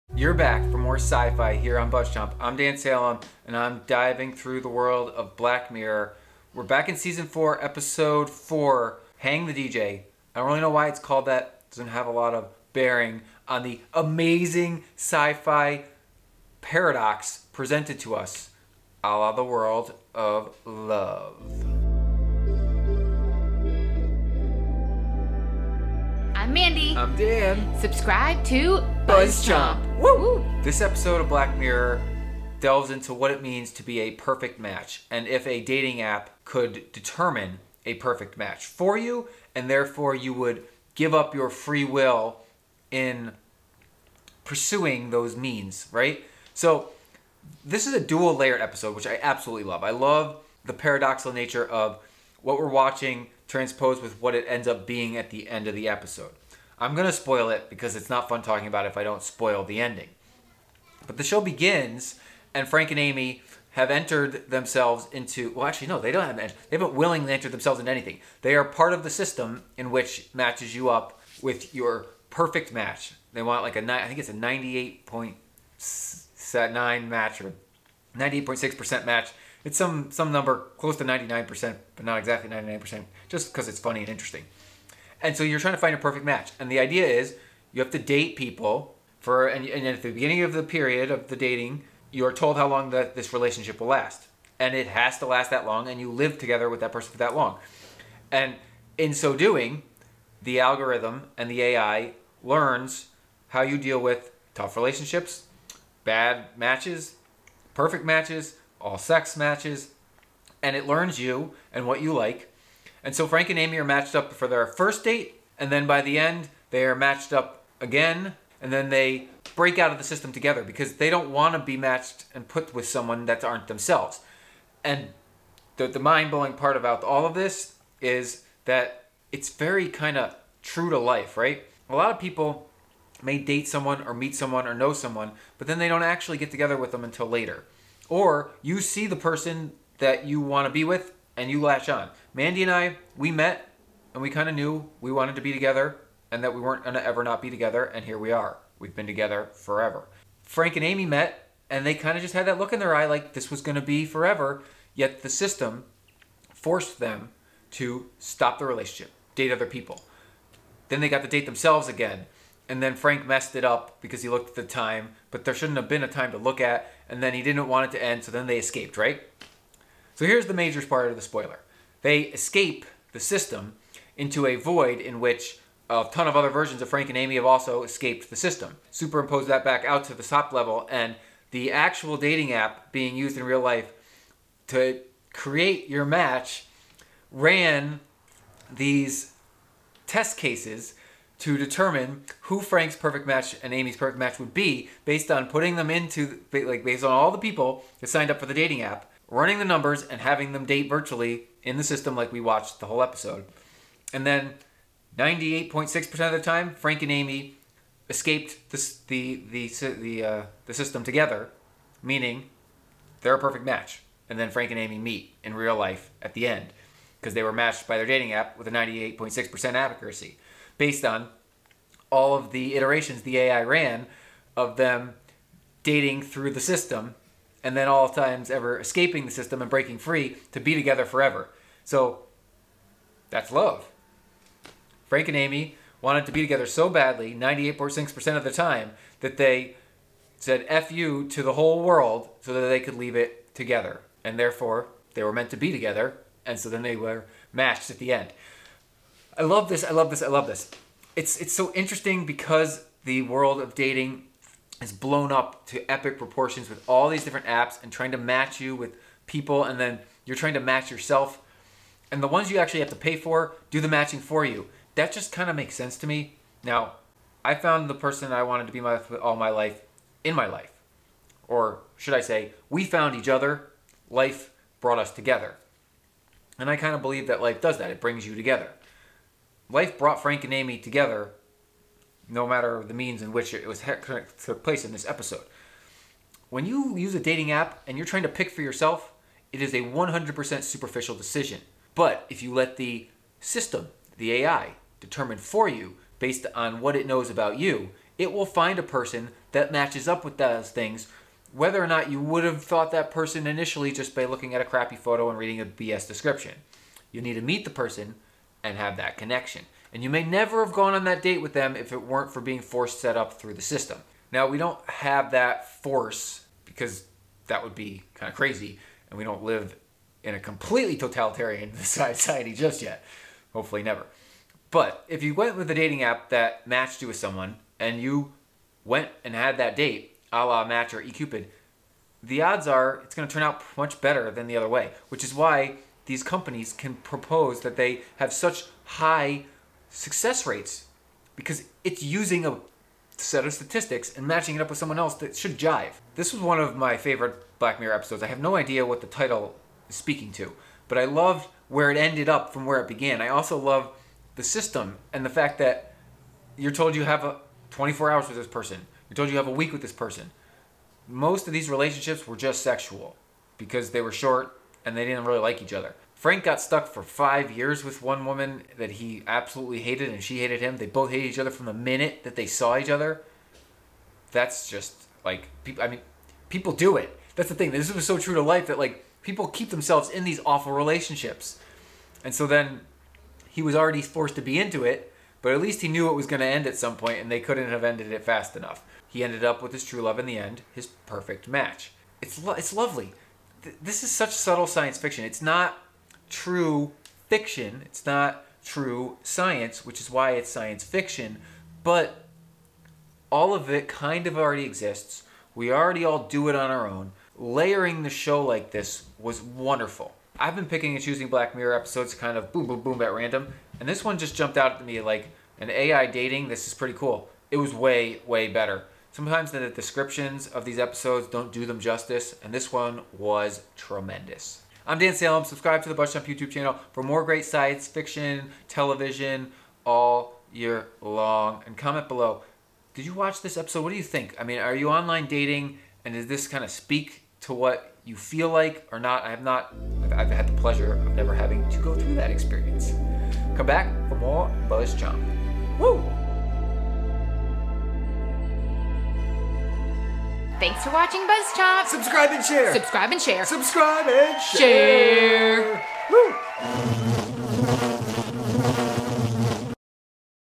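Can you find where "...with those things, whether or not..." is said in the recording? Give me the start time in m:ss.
5:00.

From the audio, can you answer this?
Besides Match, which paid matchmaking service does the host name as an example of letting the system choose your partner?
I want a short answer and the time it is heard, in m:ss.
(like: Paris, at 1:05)
eCupid, at 5:31.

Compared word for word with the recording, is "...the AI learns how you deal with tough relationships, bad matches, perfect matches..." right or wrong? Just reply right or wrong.
right.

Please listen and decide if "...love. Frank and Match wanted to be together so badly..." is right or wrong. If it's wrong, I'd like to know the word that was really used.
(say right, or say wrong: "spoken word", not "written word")
wrong: "Amy", not "Match".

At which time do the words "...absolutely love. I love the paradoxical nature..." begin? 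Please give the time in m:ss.
0:49.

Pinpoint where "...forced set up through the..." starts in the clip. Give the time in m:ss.
5:12.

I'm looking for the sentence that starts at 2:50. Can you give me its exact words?
So here's the major part of the spoiler.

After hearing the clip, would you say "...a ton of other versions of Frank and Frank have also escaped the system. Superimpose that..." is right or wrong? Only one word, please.
wrong.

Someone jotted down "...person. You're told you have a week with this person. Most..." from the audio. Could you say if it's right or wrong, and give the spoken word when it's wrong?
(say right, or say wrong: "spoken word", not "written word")
right.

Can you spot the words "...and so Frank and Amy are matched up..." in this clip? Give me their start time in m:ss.
1:53.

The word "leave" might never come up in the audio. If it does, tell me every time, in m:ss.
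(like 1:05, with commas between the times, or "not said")
4:02.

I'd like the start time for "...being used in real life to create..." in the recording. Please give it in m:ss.
3:02.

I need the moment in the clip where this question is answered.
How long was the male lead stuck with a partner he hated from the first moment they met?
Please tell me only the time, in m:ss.
6:07.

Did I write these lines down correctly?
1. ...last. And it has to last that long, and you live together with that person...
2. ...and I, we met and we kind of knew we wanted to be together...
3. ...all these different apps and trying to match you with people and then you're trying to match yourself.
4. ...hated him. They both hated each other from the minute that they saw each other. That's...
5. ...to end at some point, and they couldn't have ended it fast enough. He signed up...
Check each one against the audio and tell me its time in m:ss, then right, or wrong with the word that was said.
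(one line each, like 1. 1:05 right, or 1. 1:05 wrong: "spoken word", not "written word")
1. 1:33 right
2. 2:22 right
3. 4:16 right
4. 6:10 right
5. 6:26 wrong: "ended", not "signed".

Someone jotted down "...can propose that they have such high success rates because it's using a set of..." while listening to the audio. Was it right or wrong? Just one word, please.
right.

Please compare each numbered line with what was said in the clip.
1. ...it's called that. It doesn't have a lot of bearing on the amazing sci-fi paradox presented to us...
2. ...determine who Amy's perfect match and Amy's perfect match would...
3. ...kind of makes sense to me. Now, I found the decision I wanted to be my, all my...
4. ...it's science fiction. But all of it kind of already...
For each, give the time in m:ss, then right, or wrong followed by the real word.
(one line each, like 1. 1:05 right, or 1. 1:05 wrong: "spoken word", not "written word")
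1. 0:10 right
2. 3:11 wrong: "Frank", not "Amy"
3. 4:25 wrong: "person", not "decision"
4. 6:40 right.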